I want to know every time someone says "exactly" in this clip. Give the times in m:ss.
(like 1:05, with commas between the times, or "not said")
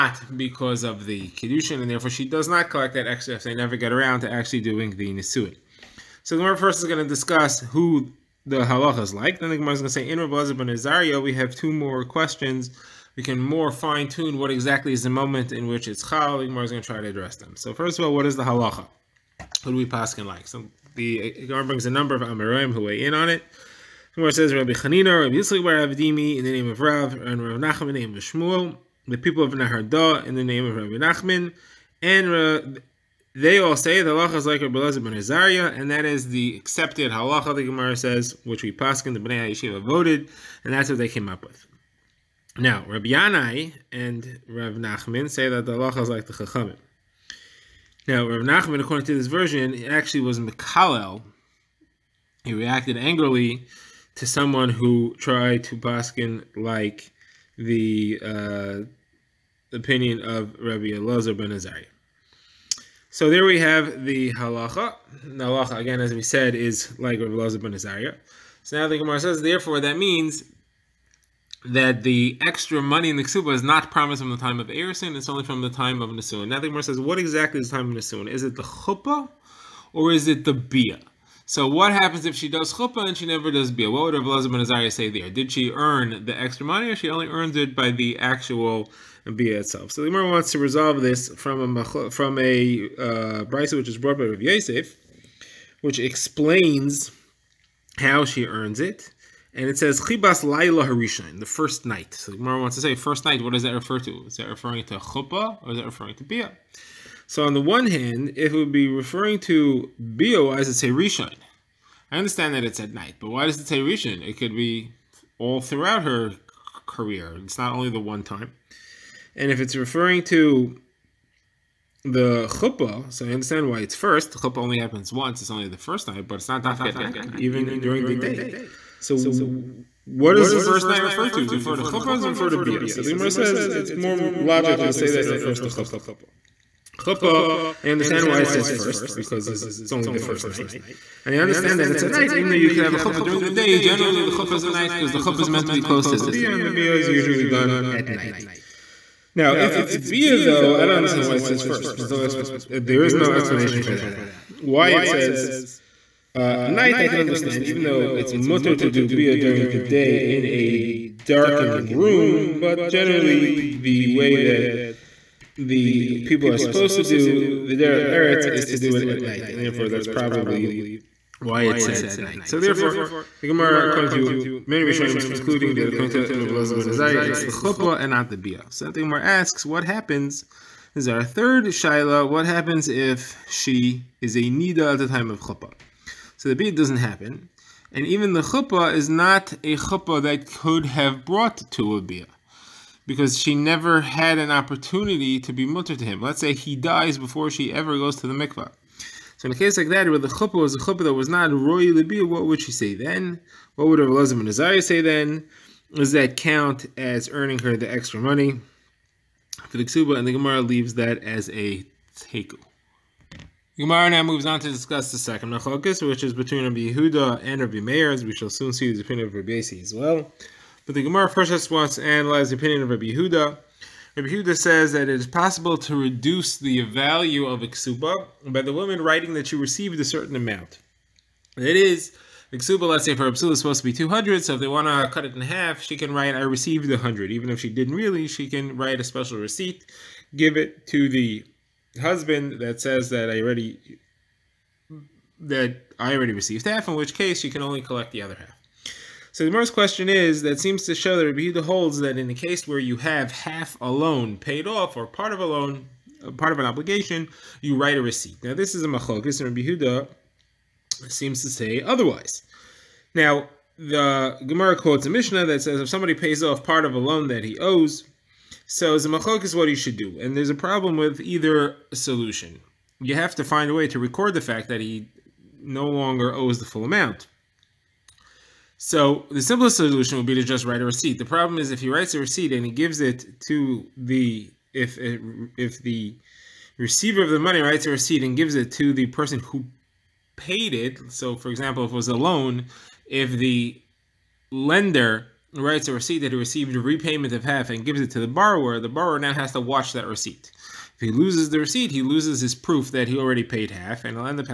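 0:14, 1:17.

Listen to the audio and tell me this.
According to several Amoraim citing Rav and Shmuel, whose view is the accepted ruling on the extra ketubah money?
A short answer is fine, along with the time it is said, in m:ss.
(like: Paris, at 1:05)
Rabbi Elazar ben Azaria, at 0:34.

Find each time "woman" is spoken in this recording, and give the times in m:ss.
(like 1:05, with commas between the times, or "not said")
3:48.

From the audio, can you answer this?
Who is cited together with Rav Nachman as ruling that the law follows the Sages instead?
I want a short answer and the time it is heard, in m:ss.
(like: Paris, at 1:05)
Rabbi Yanai, at 0:42.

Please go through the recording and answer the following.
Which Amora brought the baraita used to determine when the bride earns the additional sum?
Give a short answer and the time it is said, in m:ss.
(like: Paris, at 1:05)
Rav Yosef, at 1:34.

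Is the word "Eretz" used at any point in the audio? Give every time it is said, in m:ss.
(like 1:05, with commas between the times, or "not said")
2:48.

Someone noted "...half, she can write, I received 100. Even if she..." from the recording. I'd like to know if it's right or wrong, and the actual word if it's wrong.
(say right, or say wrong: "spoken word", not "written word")
right.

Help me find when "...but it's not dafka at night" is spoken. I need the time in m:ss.
2:06.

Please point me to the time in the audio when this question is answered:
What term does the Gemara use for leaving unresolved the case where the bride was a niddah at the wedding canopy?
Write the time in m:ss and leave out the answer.
3:32.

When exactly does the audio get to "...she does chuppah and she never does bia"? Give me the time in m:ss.
1:22.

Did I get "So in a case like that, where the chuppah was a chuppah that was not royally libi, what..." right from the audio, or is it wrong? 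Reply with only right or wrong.
right.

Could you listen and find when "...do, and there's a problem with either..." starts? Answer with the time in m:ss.
4:29.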